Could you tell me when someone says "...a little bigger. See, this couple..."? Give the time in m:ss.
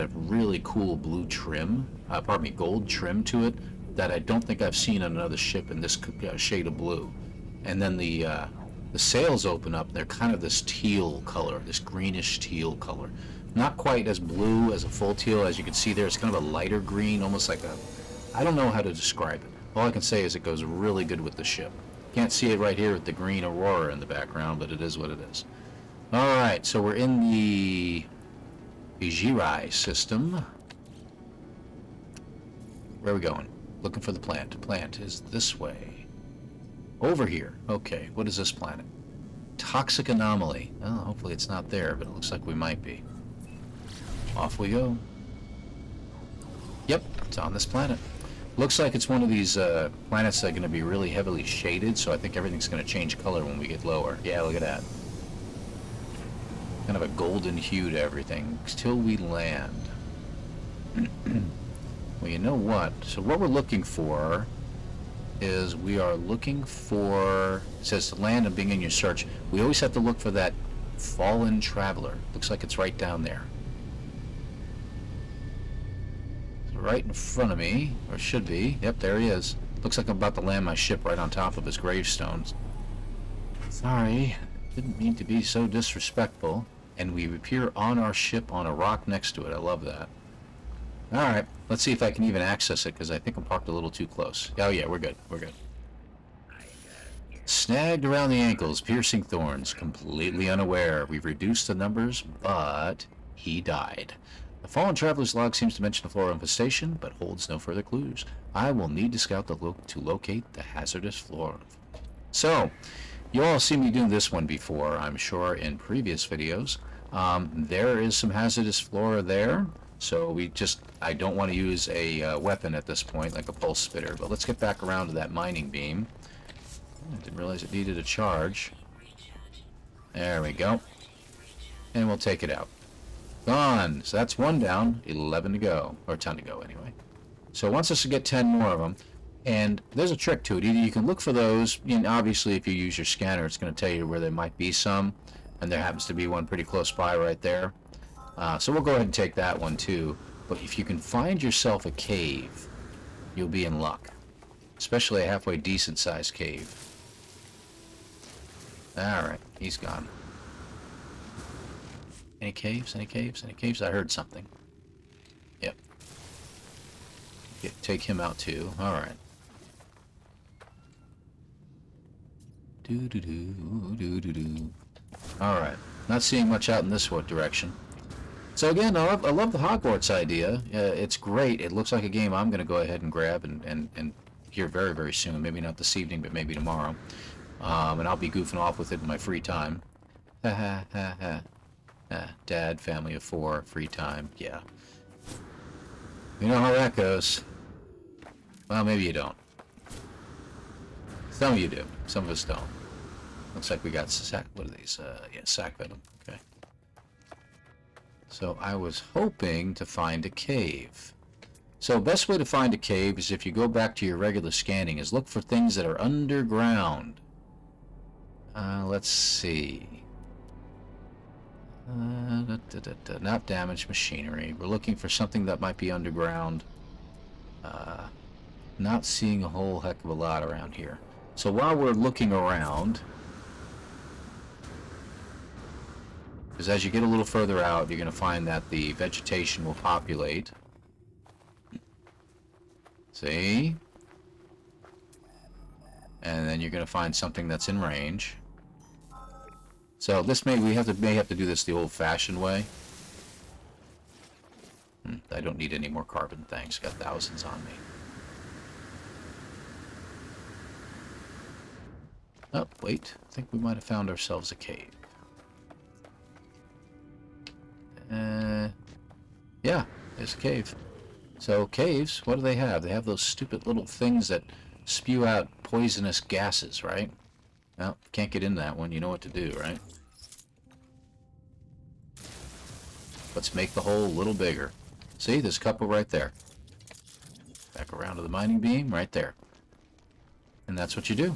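4:44.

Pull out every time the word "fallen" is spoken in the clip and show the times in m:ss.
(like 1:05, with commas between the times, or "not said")
1:10, 1:44.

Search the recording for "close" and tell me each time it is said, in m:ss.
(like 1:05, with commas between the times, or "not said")
1:34, 2:26.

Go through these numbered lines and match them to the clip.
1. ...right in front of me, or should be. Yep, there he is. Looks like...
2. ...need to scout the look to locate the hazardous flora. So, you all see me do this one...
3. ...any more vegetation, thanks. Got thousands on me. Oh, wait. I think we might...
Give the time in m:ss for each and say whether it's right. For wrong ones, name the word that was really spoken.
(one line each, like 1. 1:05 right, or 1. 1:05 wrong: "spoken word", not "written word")
1. 1:16 right
2. 1:48 right
3. 4:15 wrong: "carbon", not "vegetation".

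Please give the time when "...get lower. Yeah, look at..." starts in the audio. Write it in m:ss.
0:53.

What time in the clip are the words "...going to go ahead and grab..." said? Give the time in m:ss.
3:02.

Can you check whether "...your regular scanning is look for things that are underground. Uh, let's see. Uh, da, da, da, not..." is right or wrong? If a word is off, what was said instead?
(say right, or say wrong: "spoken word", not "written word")
right.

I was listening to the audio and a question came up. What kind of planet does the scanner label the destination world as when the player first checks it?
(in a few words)
Toxic anomaly.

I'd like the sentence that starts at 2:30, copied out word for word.
But if you can find yourself a cave, you'll be in luck.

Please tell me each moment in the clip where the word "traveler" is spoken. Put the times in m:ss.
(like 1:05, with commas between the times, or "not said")
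1:11, 1:44.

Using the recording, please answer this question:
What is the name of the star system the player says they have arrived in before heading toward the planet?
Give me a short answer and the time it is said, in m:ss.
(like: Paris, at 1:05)
Ijirai, at 0:28.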